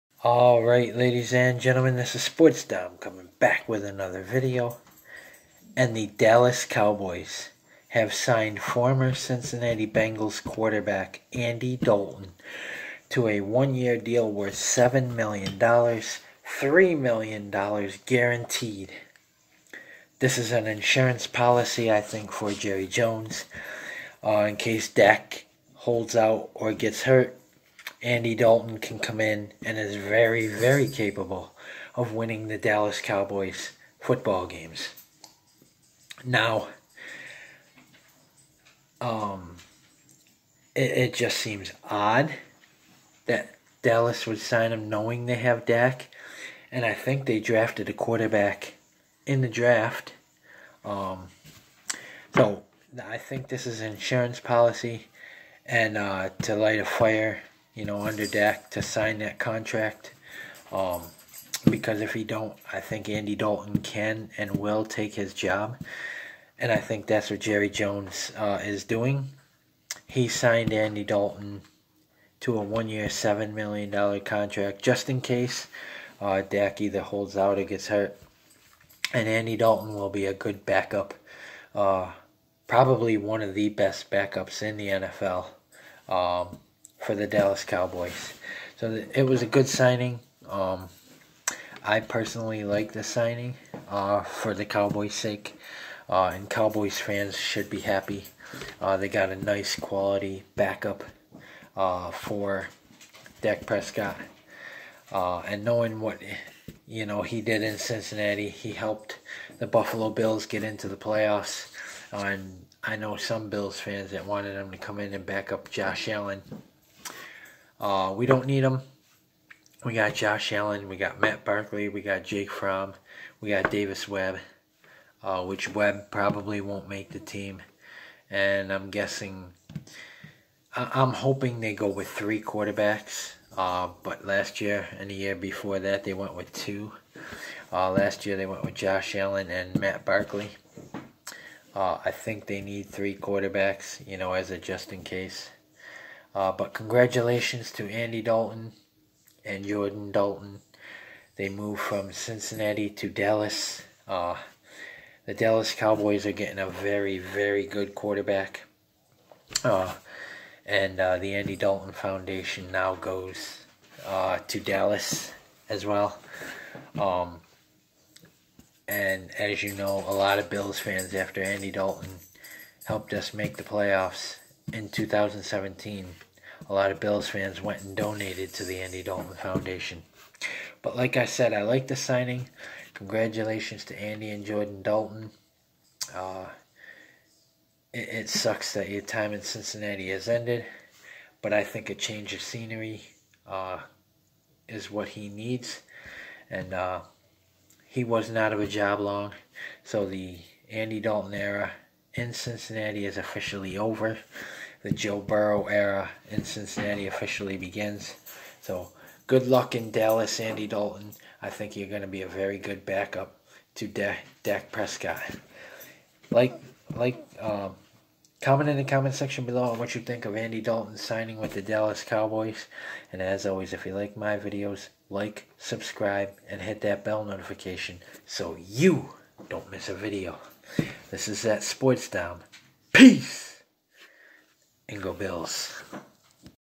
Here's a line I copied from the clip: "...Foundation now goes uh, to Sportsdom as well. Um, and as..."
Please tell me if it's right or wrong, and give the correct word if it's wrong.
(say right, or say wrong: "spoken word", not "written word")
wrong: "Dallas", not "Sportsdom".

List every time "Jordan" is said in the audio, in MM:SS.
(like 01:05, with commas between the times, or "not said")
02:29, 03:04.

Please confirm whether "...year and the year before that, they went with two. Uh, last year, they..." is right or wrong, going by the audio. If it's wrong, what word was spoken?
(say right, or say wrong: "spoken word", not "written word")
right.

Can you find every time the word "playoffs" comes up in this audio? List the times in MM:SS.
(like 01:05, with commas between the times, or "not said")
01:50, 02:53.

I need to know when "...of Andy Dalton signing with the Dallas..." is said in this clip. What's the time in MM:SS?
03:40.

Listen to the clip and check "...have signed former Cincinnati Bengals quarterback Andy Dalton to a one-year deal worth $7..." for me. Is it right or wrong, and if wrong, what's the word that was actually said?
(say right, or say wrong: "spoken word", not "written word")
right.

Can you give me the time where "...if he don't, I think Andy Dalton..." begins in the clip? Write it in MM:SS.
01:02.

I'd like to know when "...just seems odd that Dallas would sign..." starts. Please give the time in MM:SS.
00:41.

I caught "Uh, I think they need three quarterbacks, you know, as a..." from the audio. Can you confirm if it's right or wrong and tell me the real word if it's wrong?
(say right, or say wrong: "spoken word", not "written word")
right.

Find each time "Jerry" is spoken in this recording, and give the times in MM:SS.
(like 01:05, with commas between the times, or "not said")
00:22, 01:07.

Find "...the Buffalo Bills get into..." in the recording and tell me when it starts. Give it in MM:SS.
01:49.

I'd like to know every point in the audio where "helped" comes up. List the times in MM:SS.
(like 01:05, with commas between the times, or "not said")
01:48, 02:52.